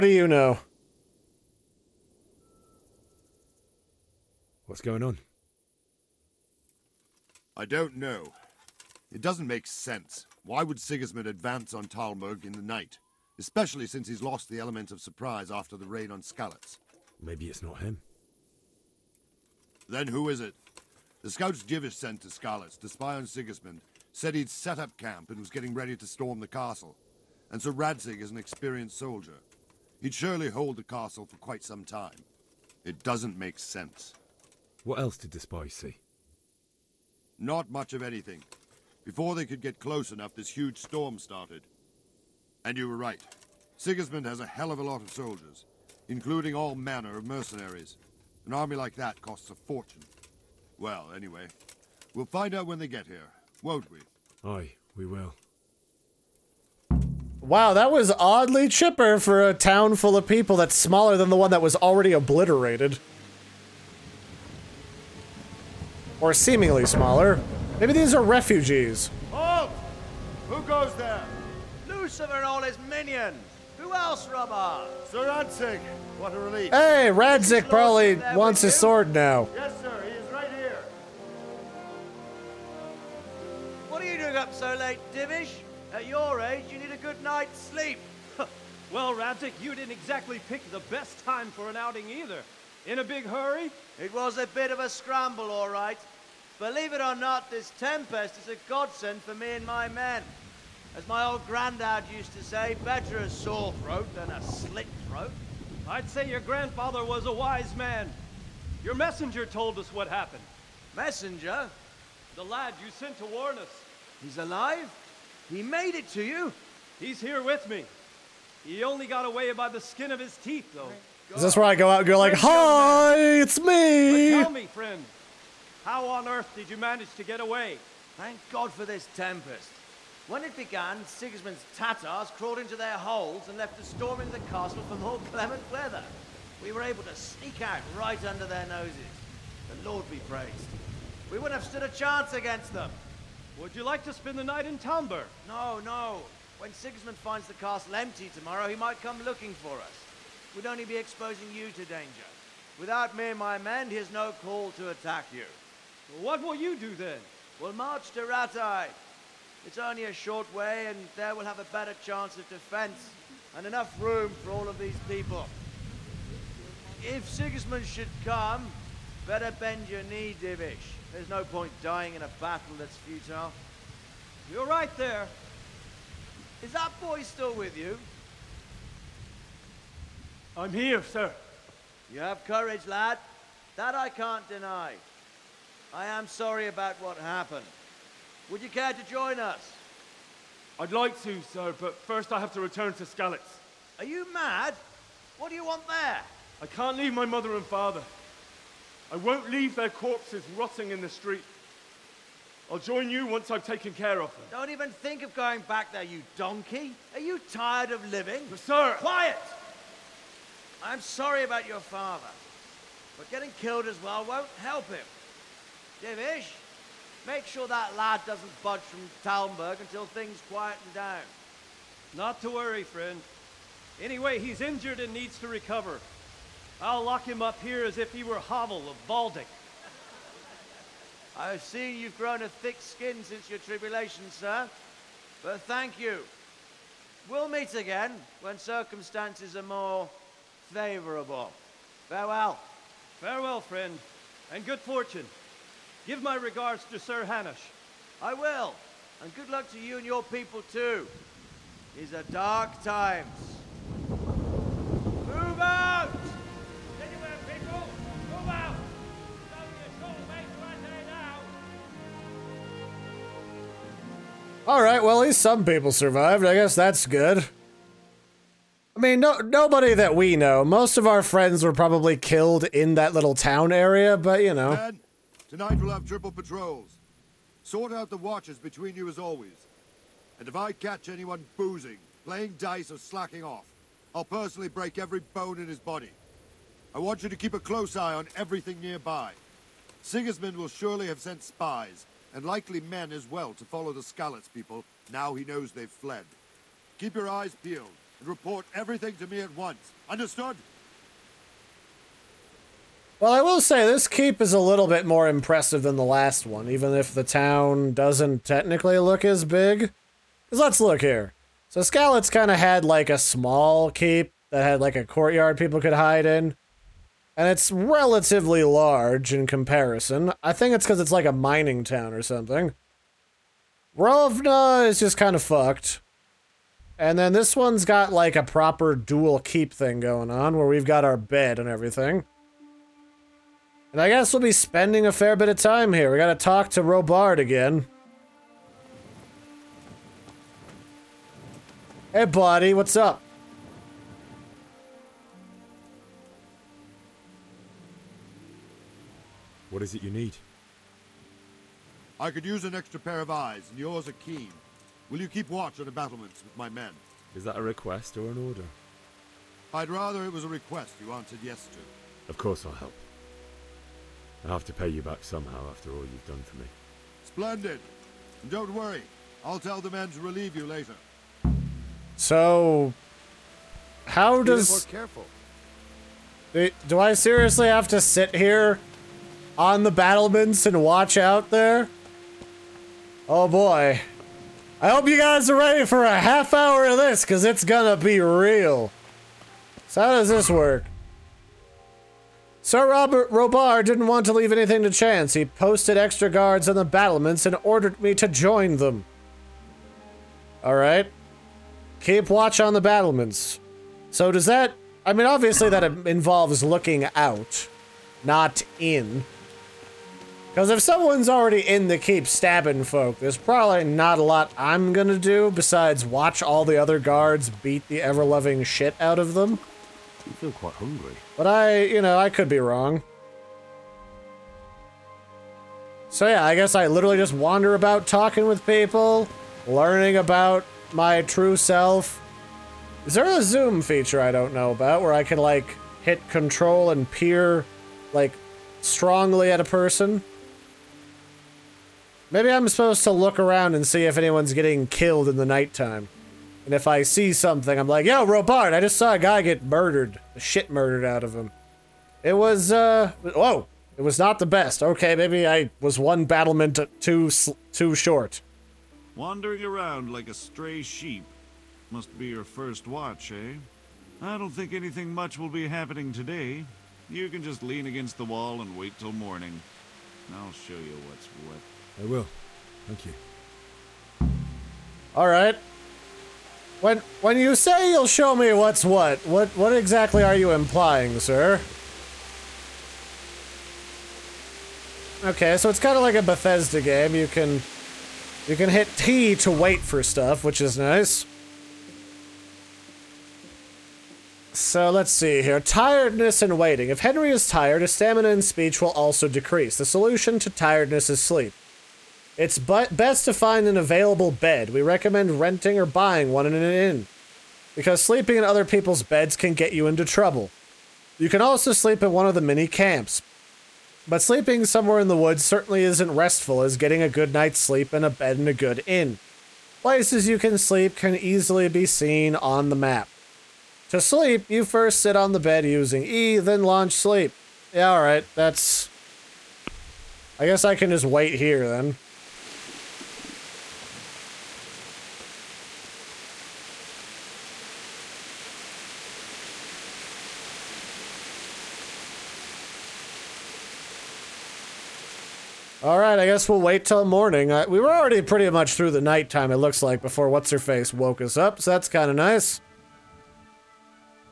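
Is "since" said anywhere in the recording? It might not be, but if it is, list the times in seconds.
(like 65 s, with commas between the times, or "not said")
13 s, 233 s.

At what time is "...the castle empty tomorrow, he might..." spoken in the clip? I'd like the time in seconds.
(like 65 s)
147 s.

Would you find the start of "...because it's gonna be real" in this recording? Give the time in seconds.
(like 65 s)
387 s.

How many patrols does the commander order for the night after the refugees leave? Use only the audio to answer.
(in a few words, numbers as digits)
Triple.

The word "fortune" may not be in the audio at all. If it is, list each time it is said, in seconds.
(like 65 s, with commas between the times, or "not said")
49 s, 244 s.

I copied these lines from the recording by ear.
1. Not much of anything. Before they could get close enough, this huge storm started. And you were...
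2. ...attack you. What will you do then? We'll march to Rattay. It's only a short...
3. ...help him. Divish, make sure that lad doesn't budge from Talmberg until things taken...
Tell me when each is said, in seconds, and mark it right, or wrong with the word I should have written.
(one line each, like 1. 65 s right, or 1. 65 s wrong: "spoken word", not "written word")
1. 37 s right
2. 154 s right
3. 214 s wrong: "quieten", not "taken".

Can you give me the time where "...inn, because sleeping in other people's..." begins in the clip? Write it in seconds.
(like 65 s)
506 s.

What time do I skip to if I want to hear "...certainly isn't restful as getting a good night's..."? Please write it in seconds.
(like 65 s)
515 s.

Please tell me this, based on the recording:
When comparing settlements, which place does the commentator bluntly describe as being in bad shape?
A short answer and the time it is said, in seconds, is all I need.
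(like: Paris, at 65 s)
Rovna, at 323 s.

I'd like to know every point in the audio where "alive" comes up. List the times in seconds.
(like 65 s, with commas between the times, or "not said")
114 s.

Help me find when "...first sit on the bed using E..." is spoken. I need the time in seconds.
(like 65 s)
524 s.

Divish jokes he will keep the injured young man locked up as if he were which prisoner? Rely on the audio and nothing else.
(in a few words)
Havel of Baldic.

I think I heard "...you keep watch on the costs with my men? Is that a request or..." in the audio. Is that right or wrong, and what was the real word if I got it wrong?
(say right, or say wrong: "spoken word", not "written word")
wrong: "battlements", not "costs".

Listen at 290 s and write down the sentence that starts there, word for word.
Sigismund will surely have sent spies, and likely men as well, to follow the Skalitz people now he knows they've fled.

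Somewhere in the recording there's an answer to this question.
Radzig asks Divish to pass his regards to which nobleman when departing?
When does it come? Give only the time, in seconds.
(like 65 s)
246 s.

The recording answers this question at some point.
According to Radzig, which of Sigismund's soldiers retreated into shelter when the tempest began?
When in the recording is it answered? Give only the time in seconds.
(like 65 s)
131 s.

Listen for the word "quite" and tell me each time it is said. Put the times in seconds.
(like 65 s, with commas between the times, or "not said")
31 s, 420 s.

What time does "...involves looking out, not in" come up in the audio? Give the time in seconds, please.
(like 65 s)
406 s.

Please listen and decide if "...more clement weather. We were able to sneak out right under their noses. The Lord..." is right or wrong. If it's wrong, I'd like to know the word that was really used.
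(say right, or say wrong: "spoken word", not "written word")
right.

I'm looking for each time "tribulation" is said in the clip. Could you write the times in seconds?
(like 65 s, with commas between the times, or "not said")
233 s.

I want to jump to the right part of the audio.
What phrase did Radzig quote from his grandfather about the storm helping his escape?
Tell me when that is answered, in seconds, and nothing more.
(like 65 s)
102 s.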